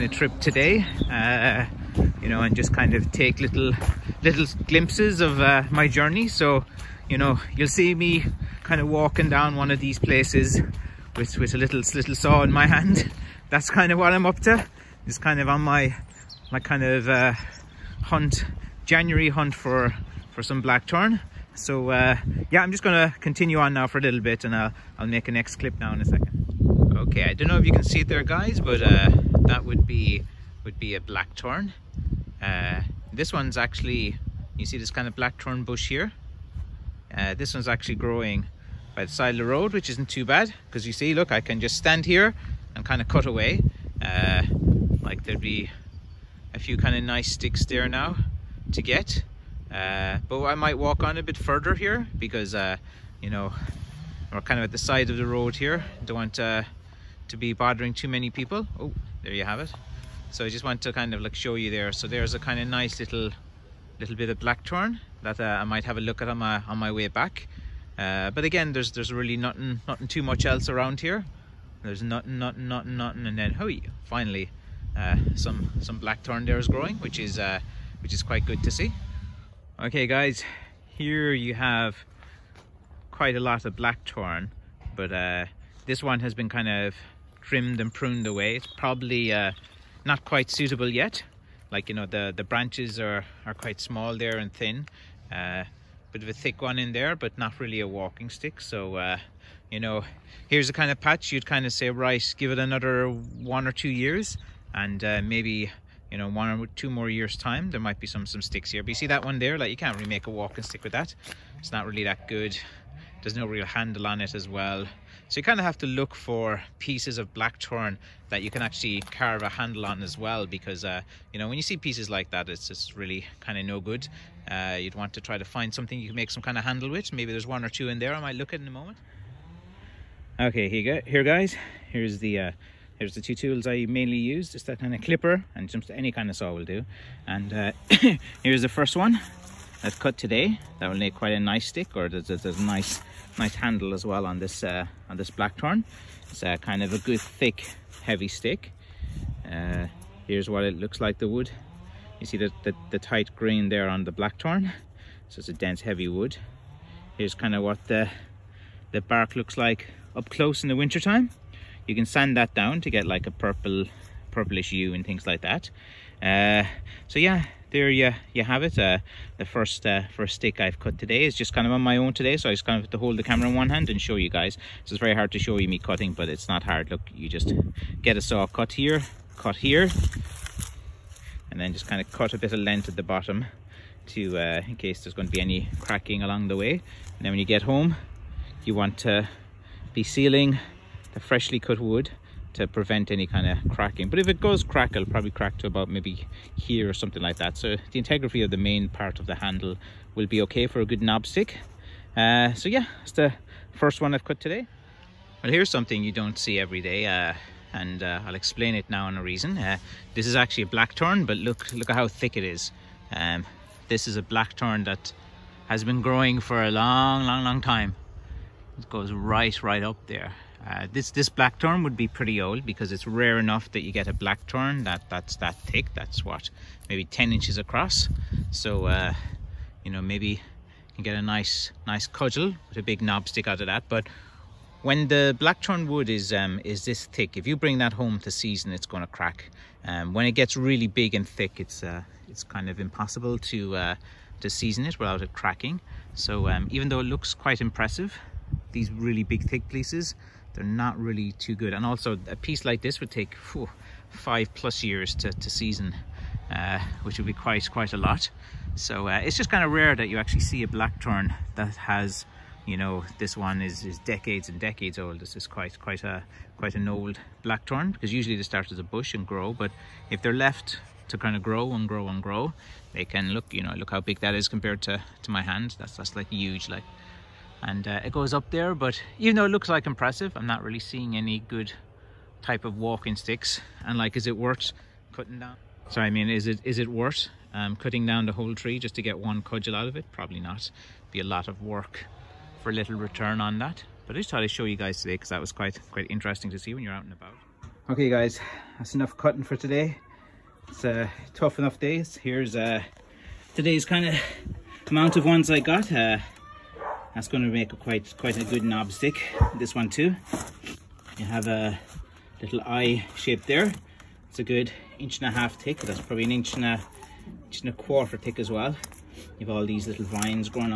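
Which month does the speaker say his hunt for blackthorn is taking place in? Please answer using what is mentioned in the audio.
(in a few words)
January.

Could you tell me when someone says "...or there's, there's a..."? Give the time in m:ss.
2:21.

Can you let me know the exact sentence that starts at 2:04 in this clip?
Uh, you'd want to try to find something you can make some kind of handle with.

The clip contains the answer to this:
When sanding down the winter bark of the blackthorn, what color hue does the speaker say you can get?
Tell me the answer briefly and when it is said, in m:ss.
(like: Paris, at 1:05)
purplish, at 2:44.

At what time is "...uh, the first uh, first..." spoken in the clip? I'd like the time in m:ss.
2:48.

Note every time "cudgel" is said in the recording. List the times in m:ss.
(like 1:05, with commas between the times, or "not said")
3:52, 4:49.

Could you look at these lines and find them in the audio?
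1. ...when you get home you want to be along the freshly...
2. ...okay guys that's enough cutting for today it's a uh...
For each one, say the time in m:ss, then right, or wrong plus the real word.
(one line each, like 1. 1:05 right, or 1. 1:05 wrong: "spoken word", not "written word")
1. 3:07 wrong: "sealing", not "along"
2. 4:57 right.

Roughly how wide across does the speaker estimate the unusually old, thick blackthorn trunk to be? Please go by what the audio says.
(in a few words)
10 inches.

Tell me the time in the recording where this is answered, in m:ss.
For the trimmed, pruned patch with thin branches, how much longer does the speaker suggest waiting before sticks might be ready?
1:43.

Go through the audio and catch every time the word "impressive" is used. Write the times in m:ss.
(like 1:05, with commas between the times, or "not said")
4:07, 4:39.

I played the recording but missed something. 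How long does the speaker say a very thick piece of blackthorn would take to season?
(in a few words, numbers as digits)
5 plus years.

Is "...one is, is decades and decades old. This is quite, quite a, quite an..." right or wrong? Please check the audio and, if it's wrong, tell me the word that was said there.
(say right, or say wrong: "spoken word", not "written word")
right.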